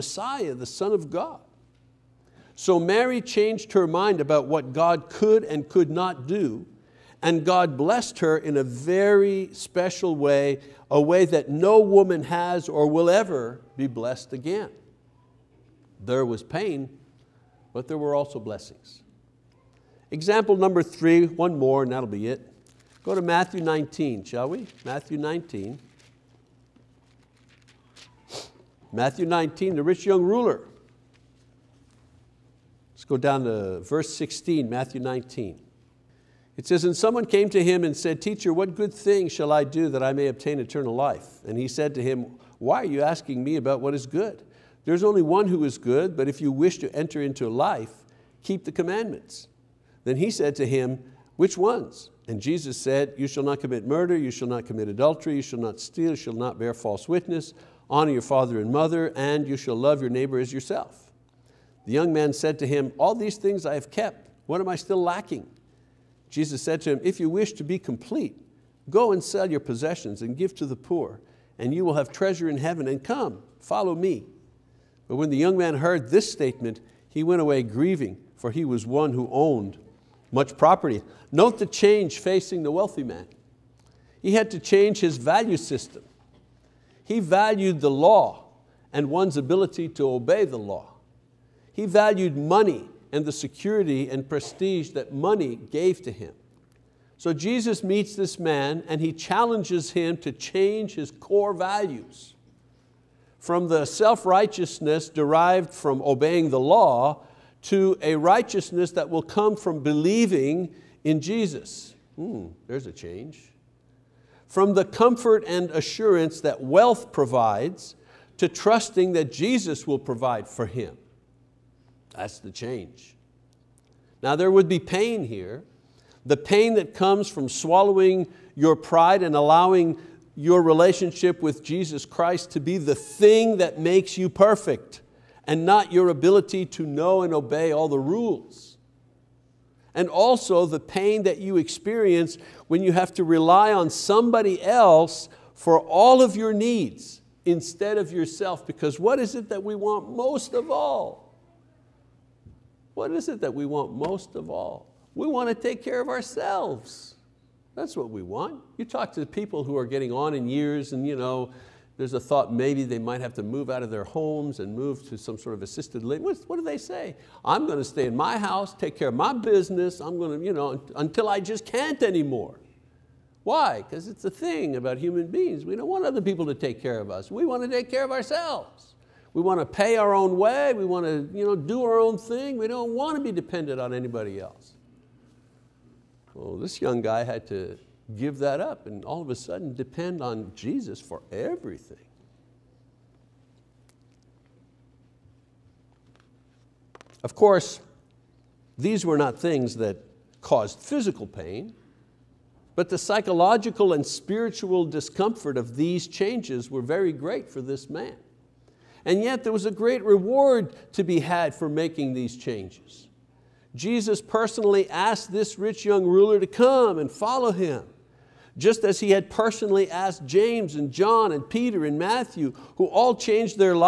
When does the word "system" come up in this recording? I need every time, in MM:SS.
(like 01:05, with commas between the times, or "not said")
01:25.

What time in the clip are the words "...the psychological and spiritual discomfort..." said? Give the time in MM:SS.
03:22.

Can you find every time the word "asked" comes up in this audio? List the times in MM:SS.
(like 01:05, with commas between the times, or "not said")
03:34, 03:39.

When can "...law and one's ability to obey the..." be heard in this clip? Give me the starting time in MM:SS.
01:27.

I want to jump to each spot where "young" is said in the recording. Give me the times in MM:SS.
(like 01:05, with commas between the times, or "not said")
00:30, 01:01, 01:15, 03:06, 03:35.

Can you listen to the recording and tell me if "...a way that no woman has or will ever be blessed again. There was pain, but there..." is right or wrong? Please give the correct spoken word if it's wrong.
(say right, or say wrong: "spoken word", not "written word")
right.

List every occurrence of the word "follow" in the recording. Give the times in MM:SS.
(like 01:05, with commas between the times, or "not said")
01:13, 03:37.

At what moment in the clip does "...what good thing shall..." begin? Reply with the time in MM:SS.
00:38.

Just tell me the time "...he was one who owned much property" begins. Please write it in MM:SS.
01:18.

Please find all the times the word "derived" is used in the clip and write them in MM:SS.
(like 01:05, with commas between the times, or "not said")
01:45.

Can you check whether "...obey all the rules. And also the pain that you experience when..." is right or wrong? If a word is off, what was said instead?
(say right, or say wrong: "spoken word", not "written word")
right.